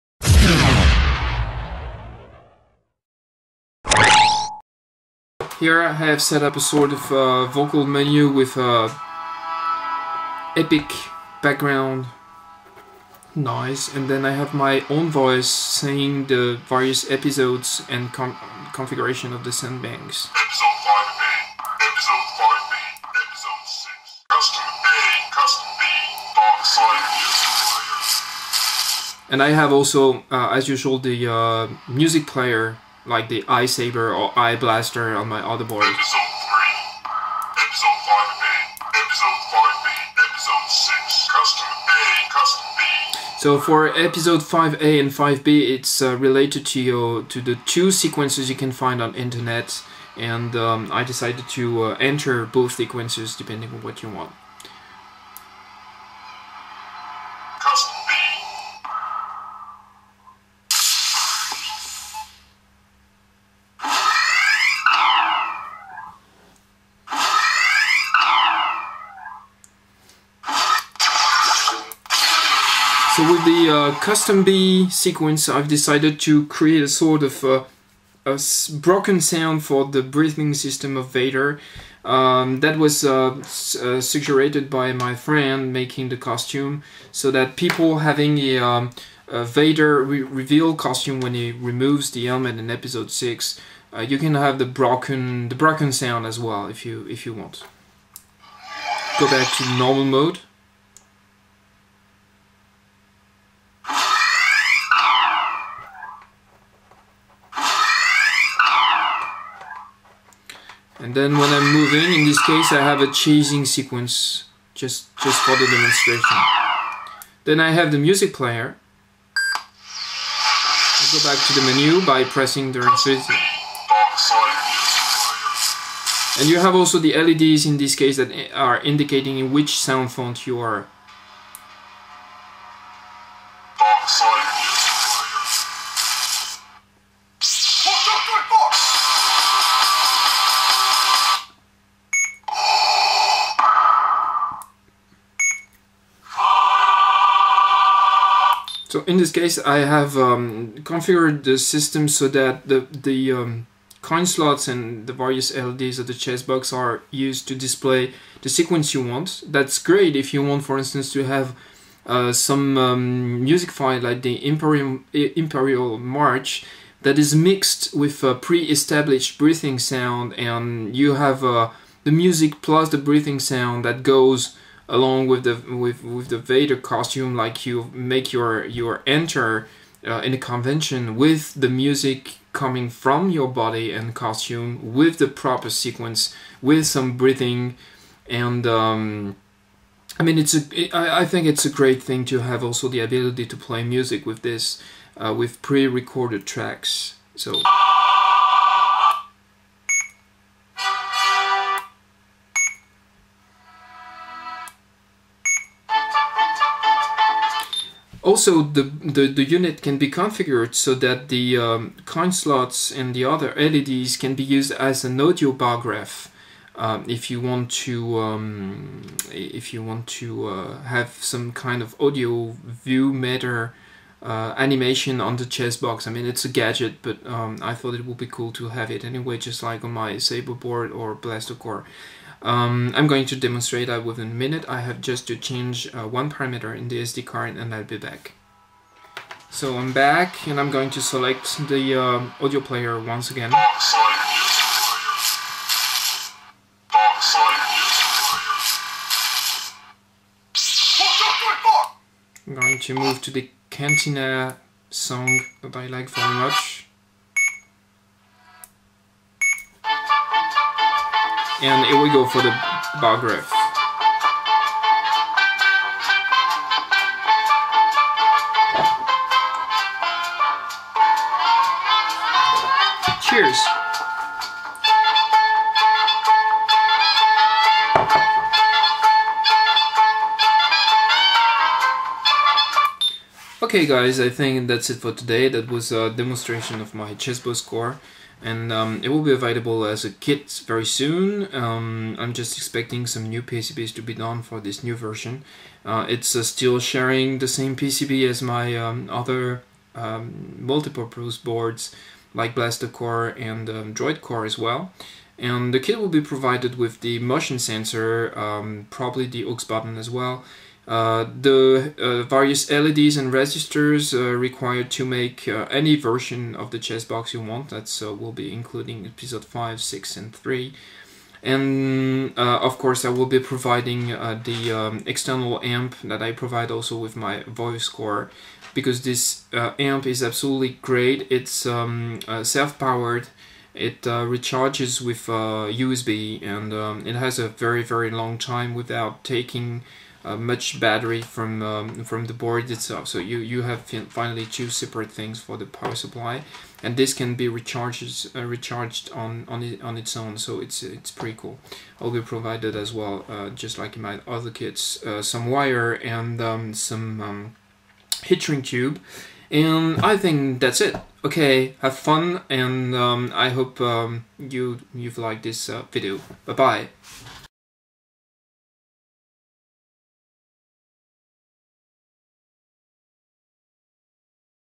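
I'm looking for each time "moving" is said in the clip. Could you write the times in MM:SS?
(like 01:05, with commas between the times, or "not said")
01:51.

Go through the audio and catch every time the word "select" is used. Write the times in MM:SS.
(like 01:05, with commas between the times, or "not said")
04:01.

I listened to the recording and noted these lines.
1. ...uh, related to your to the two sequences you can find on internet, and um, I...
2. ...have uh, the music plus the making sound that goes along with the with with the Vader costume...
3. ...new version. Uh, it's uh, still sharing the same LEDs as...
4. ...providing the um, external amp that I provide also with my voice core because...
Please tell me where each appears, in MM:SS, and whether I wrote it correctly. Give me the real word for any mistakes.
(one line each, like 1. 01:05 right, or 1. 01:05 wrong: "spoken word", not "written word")
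1. 00:46 right
2. 02:51 wrong: "breathing", not "making"
3. 04:54 wrong: "PCB", not "LEDs"
4. 05:23 right.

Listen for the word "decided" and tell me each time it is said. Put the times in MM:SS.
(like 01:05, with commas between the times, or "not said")
00:51, 01:15.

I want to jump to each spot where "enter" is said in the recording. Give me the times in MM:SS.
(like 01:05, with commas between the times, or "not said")
00:51, 02:59.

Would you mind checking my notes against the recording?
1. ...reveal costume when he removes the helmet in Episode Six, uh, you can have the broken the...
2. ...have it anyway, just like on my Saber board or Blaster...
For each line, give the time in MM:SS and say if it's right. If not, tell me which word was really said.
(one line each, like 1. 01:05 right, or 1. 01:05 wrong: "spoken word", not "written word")
1. 01:30 right
2. 03:48 right.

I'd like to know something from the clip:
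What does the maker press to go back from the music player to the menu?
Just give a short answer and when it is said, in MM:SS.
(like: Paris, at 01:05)
the resistor, at 02:02.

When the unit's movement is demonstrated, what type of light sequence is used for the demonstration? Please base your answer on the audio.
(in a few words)
chasing sequence.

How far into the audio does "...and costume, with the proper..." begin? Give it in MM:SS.
03:03.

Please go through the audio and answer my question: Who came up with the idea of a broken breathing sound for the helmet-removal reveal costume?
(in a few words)
friend making the costume.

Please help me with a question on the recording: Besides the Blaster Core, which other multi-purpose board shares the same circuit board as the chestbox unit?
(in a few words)
Droid Core.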